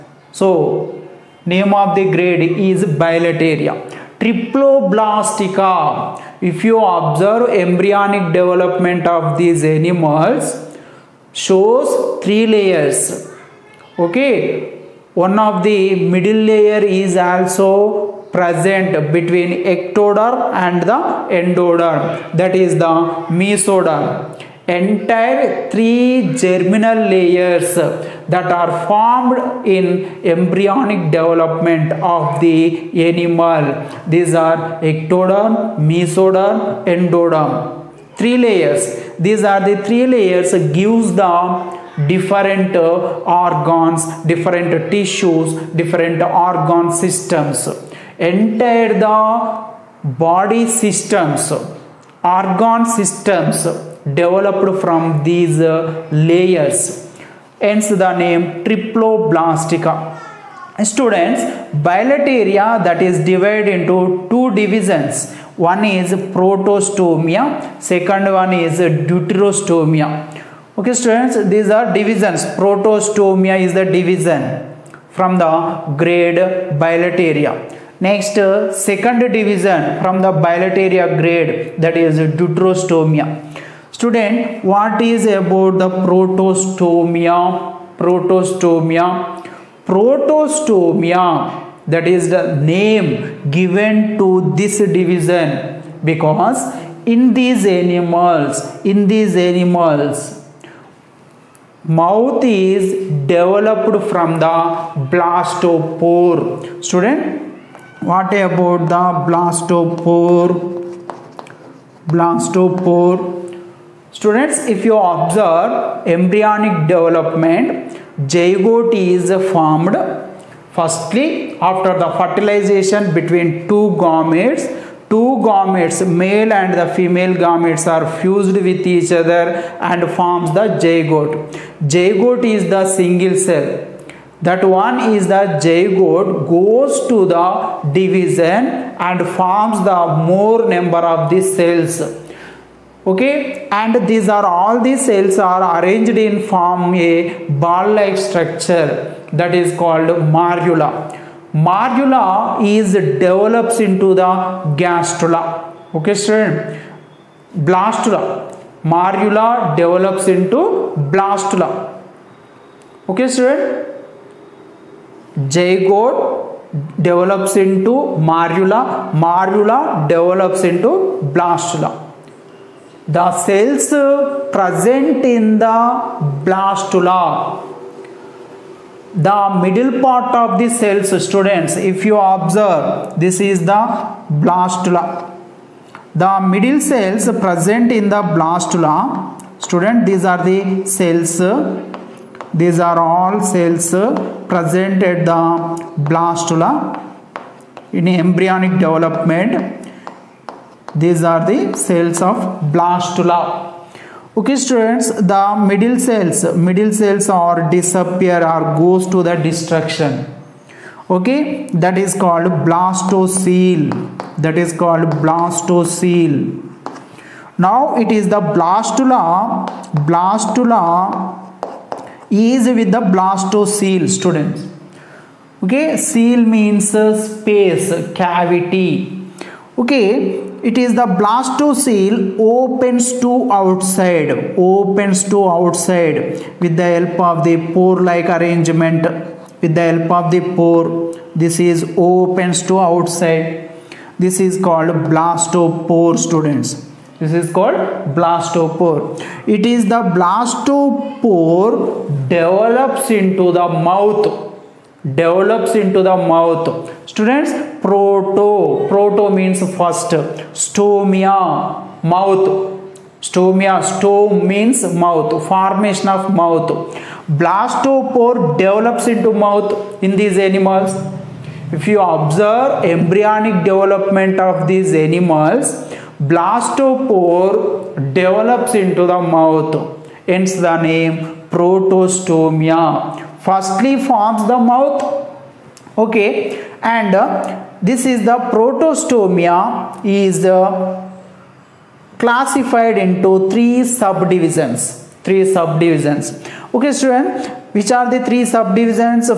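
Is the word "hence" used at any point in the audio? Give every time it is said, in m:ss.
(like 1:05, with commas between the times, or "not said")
0:57, 4:40.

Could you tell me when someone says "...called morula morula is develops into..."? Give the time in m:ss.
2:29.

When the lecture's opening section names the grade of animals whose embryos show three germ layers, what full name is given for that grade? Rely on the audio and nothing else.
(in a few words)
Bilateria triploblastica.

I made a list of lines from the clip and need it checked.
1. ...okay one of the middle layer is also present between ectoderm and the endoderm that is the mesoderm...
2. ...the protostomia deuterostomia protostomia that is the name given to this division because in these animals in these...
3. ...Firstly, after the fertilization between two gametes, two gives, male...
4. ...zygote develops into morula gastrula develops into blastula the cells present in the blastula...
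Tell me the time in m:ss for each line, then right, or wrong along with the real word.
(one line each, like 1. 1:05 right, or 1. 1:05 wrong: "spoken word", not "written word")
1. 0:14 right
2. 1:25 wrong: "protostomia", not "deuterostomia"
3. 2:00 wrong: "gametes", not "gives"
4. 2:45 wrong: "morula", not "gastrula".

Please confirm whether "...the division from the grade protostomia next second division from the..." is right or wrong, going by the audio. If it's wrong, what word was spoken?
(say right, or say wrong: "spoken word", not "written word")
wrong: "bilateria", not "protostomia".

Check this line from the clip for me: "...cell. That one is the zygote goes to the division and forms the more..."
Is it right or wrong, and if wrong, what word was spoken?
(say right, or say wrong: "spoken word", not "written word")
right.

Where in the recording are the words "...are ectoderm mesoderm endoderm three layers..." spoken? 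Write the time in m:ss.
0:34.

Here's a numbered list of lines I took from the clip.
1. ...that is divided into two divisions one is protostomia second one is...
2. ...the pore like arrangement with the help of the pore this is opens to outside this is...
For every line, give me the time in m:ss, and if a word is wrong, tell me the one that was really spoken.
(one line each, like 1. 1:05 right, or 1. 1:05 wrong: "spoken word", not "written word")
1. 1:02 right
2. 3:57 right.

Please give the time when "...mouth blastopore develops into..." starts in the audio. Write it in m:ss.
4:26.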